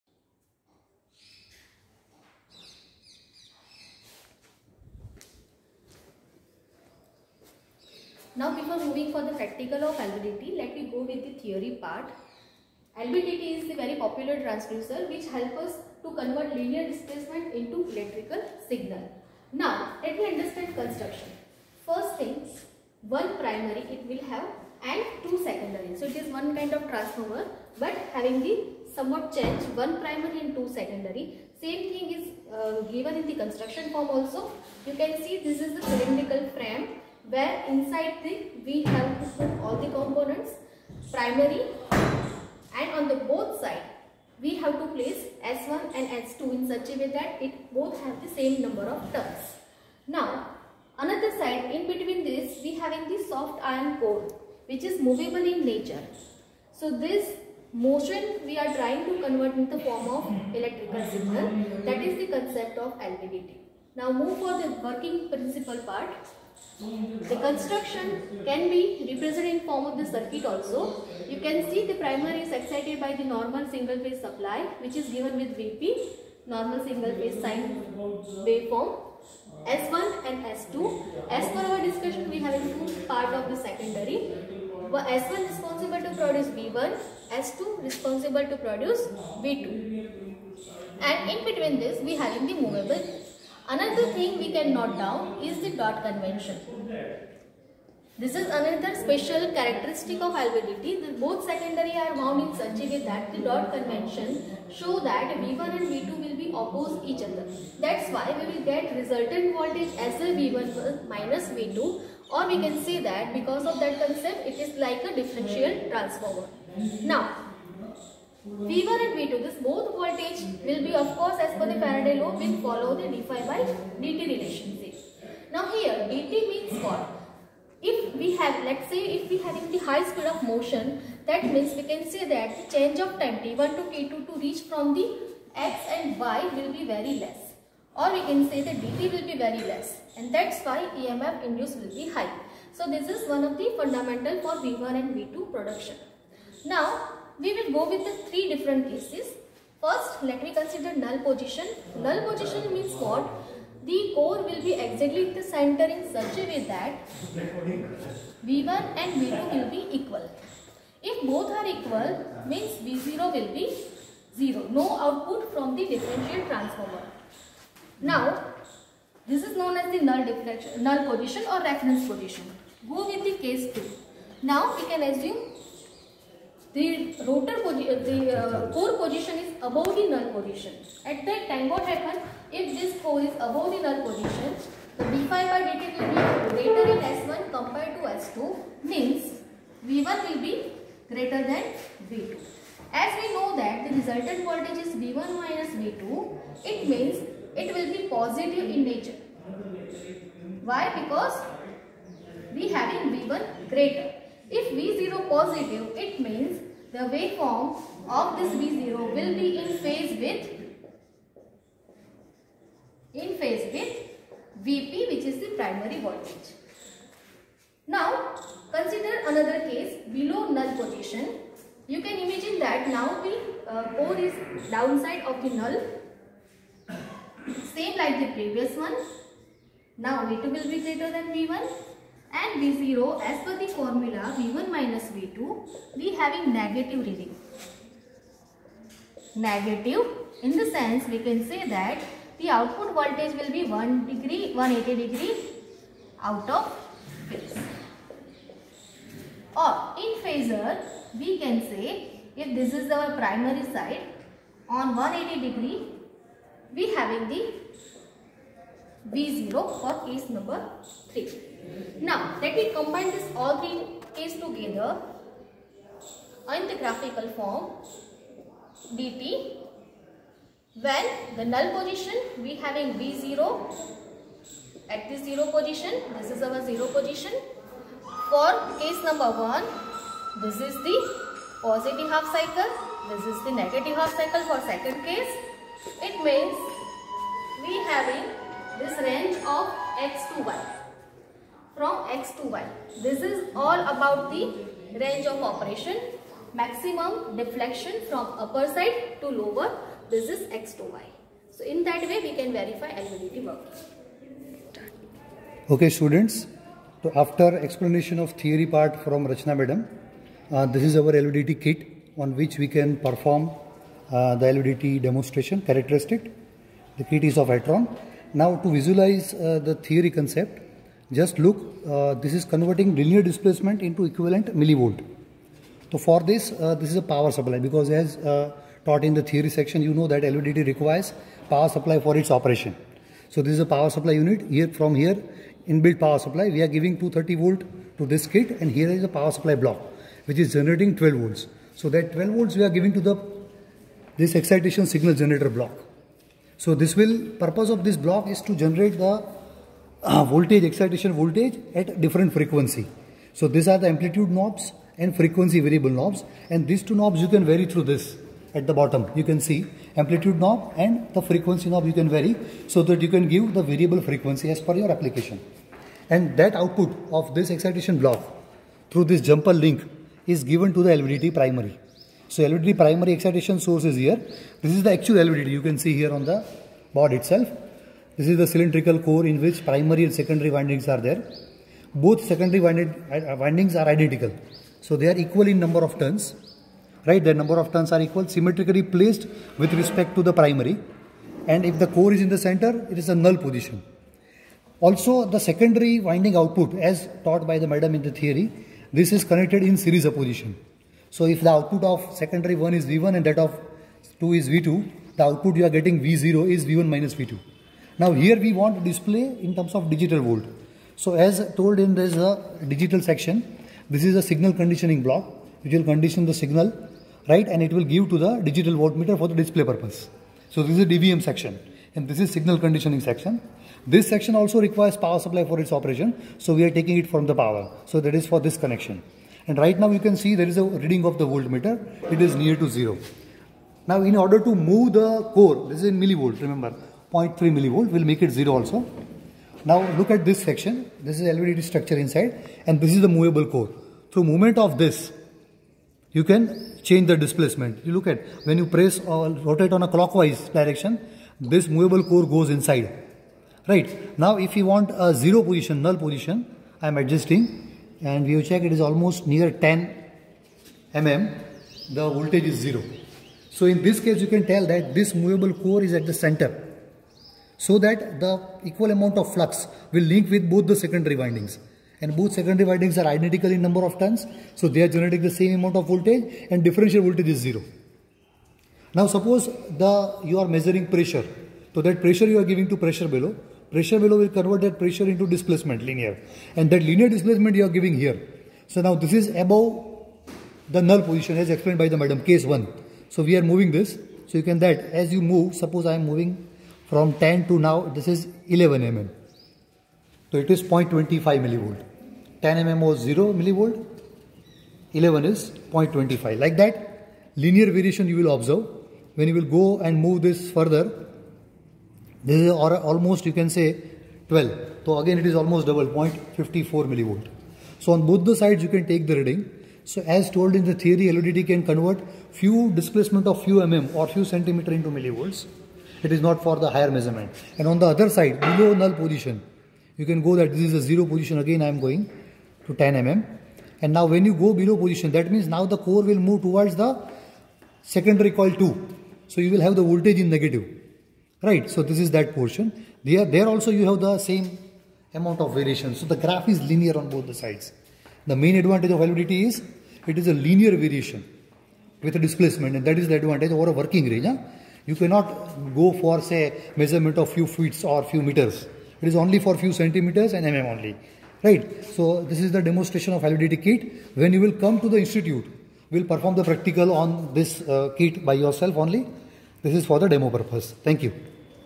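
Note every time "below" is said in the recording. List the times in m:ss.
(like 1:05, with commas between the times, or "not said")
3:40, 8:48, 8:54.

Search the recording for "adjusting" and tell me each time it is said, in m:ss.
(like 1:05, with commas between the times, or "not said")
7:36.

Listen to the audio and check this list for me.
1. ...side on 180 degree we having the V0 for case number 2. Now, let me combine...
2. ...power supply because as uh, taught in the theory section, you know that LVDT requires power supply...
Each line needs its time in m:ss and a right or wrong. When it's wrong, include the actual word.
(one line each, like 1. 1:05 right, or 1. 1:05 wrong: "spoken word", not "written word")
1. 4:13 wrong: "3", not "2"
2. 5:27 right.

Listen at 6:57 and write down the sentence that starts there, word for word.
And it will give to the digital voltmeter for the display purpose.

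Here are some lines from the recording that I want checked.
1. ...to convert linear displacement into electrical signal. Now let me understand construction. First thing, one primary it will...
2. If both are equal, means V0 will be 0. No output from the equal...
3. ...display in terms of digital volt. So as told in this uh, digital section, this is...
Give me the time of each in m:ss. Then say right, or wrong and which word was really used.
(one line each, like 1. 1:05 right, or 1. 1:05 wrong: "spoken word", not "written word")
1. 0:16 right
2. 2:41 wrong: "differential", not "equal"
3. 6:48 right.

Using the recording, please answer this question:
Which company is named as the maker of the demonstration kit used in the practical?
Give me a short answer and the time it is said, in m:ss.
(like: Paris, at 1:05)
Etron, at 5:17.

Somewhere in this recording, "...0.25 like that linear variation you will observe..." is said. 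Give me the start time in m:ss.
8:25.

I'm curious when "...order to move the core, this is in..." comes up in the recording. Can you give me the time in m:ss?
7:14.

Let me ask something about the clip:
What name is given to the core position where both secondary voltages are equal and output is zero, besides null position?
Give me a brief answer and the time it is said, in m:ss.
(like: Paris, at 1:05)
reference position, at 2:51.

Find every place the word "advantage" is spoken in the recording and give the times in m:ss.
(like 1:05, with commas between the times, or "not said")
9:08, 9:13.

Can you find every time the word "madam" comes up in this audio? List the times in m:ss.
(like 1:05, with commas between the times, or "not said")
5:09, 6:37, 8:12.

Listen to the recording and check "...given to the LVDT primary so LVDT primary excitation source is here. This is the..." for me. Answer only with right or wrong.
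right.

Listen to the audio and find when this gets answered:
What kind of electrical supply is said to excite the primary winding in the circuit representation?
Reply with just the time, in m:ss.
1:13.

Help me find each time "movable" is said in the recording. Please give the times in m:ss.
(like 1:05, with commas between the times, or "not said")
0:54, 1:32, 7:23, 7:31, 7:45.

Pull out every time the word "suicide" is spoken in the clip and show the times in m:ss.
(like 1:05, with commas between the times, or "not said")
not said.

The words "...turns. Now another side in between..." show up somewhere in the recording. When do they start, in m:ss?
0:49.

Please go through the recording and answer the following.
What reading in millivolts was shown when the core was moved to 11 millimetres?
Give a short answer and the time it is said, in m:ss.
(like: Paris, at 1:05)
0.25 millivolt, at 8:20.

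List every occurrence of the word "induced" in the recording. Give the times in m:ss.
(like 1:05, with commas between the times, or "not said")
2:21.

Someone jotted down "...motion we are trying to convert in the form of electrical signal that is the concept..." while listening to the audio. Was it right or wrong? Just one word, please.
right.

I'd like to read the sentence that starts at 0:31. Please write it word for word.
Same thing is uh, given in the construction form also.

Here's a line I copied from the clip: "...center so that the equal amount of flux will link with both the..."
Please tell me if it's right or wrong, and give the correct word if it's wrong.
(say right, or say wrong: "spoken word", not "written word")
right.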